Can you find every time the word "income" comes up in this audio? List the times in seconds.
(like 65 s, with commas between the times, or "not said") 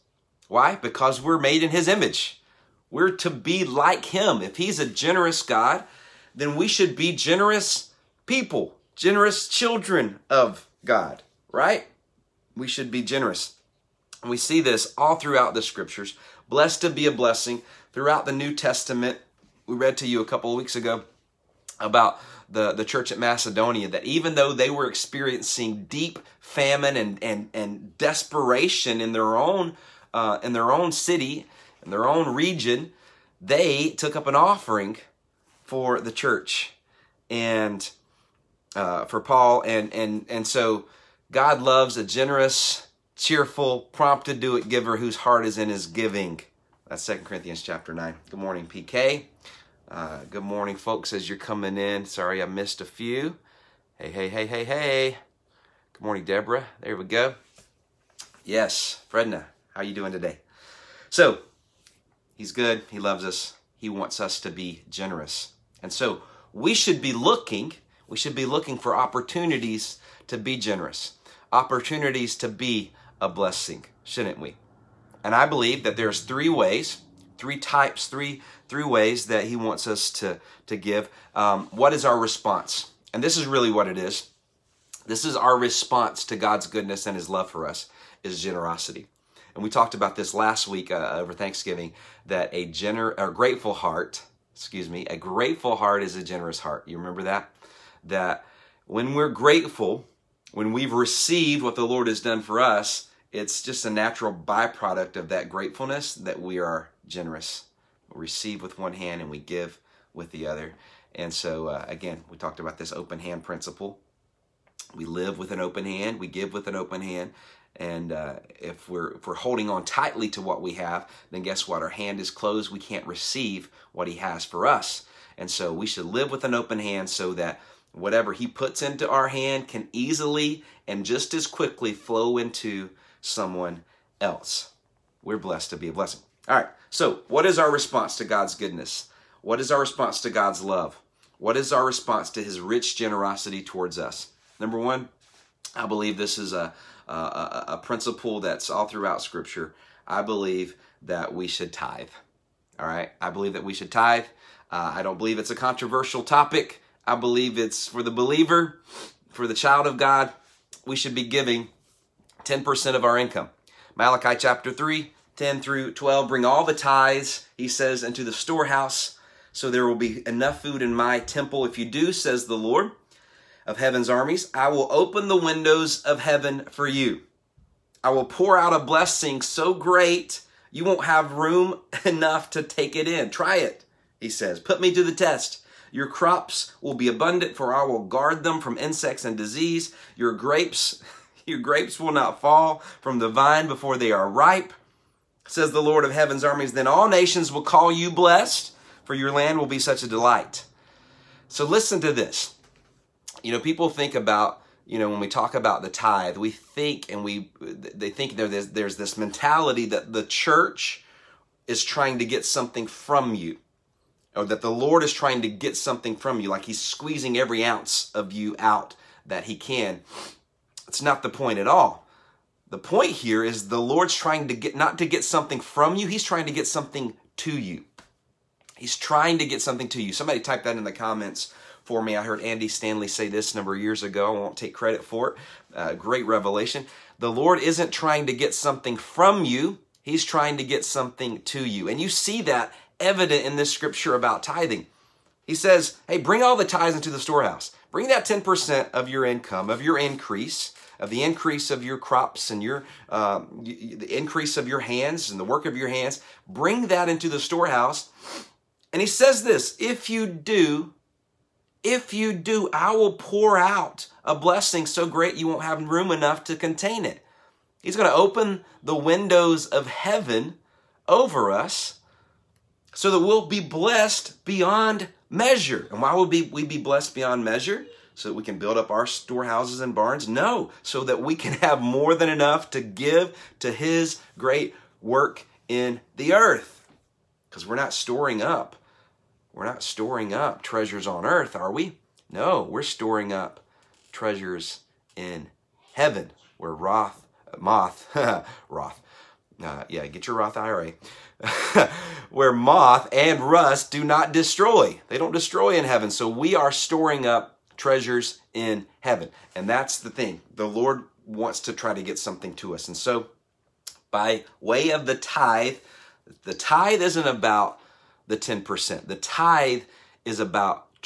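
163 s, 249 s.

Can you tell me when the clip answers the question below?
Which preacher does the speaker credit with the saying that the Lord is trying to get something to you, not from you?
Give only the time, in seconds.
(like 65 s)
232 s.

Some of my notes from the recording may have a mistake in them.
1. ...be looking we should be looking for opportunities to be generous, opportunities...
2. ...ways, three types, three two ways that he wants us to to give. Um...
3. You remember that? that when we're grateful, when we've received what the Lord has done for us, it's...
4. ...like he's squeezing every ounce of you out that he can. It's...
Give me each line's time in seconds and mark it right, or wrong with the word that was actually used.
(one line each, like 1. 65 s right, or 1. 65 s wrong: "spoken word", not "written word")
1. 67 s right
2. 76 s wrong: "three", not "two"
3. 96 s right
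4. 216 s right.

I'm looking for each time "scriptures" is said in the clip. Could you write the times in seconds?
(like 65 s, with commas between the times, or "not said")
15 s, 149 s, 243 s.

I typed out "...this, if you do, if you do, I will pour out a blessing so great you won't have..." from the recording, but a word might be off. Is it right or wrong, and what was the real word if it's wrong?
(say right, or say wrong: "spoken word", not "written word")
right.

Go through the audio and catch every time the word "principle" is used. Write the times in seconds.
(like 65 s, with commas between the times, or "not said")
113 s, 147 s.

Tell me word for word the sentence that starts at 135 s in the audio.
We're blessed to be a blessing.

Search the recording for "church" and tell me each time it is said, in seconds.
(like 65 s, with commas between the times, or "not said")
22 s, 36 s, 210 s.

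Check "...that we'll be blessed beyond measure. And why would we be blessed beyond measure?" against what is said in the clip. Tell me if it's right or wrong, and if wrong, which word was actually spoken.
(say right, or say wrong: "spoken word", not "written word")
right.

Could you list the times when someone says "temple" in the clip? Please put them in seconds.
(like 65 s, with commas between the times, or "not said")
171 s.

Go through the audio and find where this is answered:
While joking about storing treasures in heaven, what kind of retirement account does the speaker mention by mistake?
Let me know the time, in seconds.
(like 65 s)
300 s.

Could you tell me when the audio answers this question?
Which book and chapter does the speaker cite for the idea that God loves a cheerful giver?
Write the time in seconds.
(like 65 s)
47 s.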